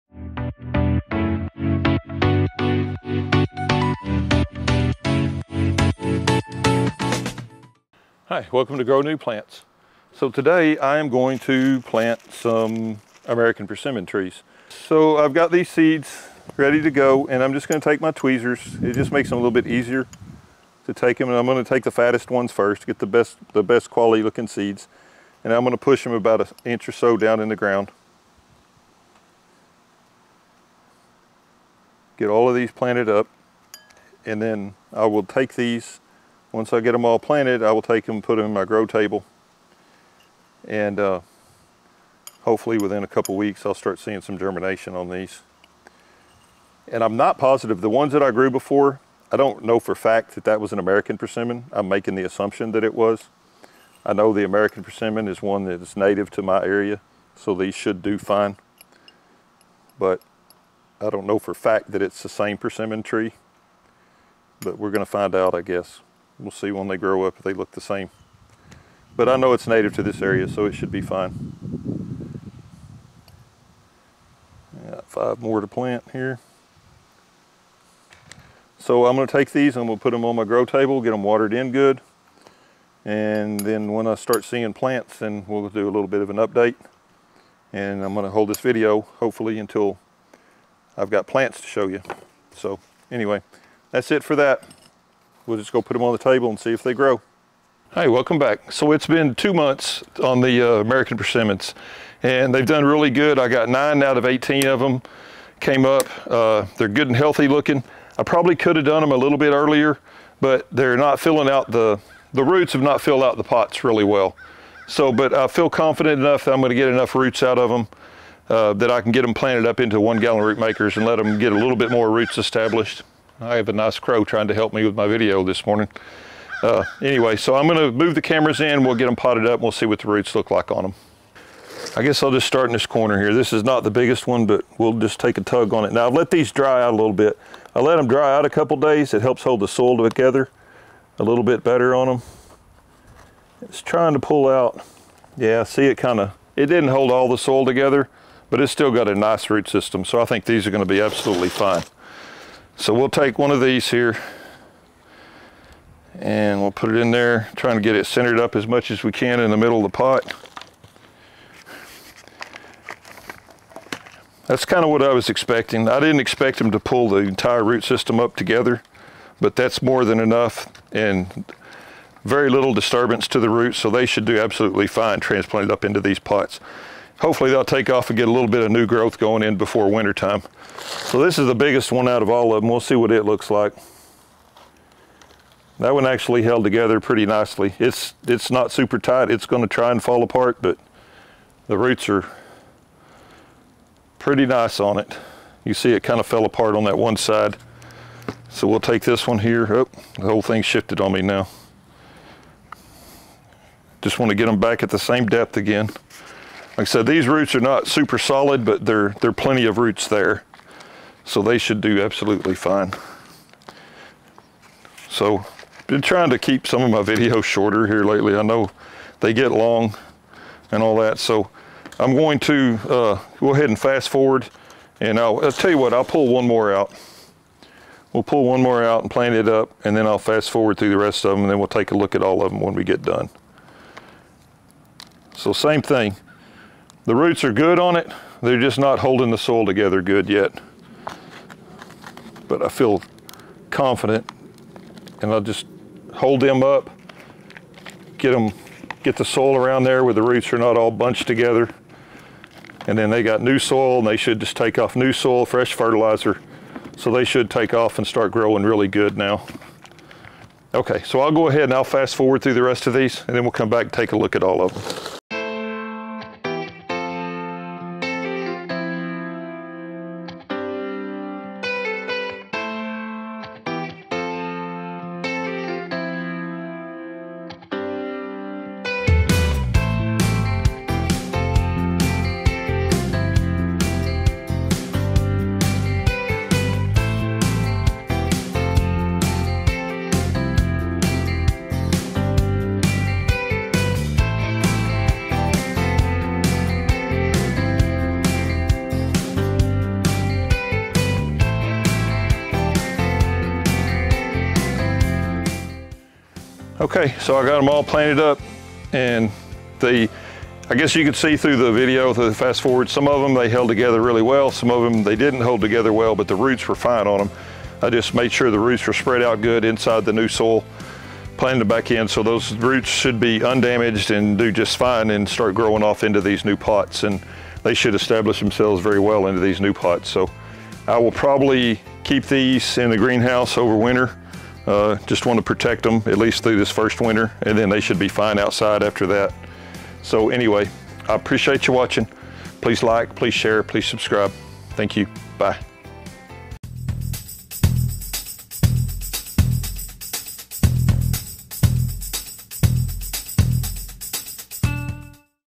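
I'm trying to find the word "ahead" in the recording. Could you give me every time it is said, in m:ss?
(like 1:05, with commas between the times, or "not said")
3:43, 4:21.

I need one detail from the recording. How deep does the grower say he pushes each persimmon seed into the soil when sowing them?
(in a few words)
about an inch.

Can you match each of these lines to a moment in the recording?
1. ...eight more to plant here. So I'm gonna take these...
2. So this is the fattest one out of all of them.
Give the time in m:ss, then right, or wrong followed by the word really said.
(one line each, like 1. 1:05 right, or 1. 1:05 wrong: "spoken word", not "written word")
1. 1:15 wrong: "five", not "eight"
2. 3:00 wrong: "biggest", not "fattest".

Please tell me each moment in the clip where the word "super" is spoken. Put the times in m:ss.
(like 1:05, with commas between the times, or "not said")
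3:08, 3:27.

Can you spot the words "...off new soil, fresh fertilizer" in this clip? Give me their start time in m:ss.
4:14.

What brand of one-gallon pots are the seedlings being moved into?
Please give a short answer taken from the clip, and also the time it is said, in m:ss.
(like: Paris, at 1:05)
Rootmakers, at 2:00.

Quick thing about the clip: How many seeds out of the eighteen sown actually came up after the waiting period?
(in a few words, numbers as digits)
9.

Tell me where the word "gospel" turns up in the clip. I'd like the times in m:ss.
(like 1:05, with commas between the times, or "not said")
not said.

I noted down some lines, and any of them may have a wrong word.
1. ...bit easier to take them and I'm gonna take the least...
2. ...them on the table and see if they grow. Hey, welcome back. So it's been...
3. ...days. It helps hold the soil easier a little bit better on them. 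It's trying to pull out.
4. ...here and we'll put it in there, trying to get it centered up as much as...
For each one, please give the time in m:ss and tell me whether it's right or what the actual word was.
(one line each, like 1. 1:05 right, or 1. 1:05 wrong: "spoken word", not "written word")
1. 0:19 wrong: "fattest", not "least"
2. 1:35 right
3. 2:18 wrong: "together", not "easier"
4. 2:33 right.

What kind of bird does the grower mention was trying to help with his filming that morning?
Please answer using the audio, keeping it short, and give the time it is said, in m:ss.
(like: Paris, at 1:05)
crow, at 2:03.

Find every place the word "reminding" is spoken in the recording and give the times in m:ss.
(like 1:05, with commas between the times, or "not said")
not said.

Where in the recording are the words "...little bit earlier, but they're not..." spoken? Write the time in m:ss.
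1:49.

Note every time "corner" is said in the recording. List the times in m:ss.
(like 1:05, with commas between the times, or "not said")
2:12.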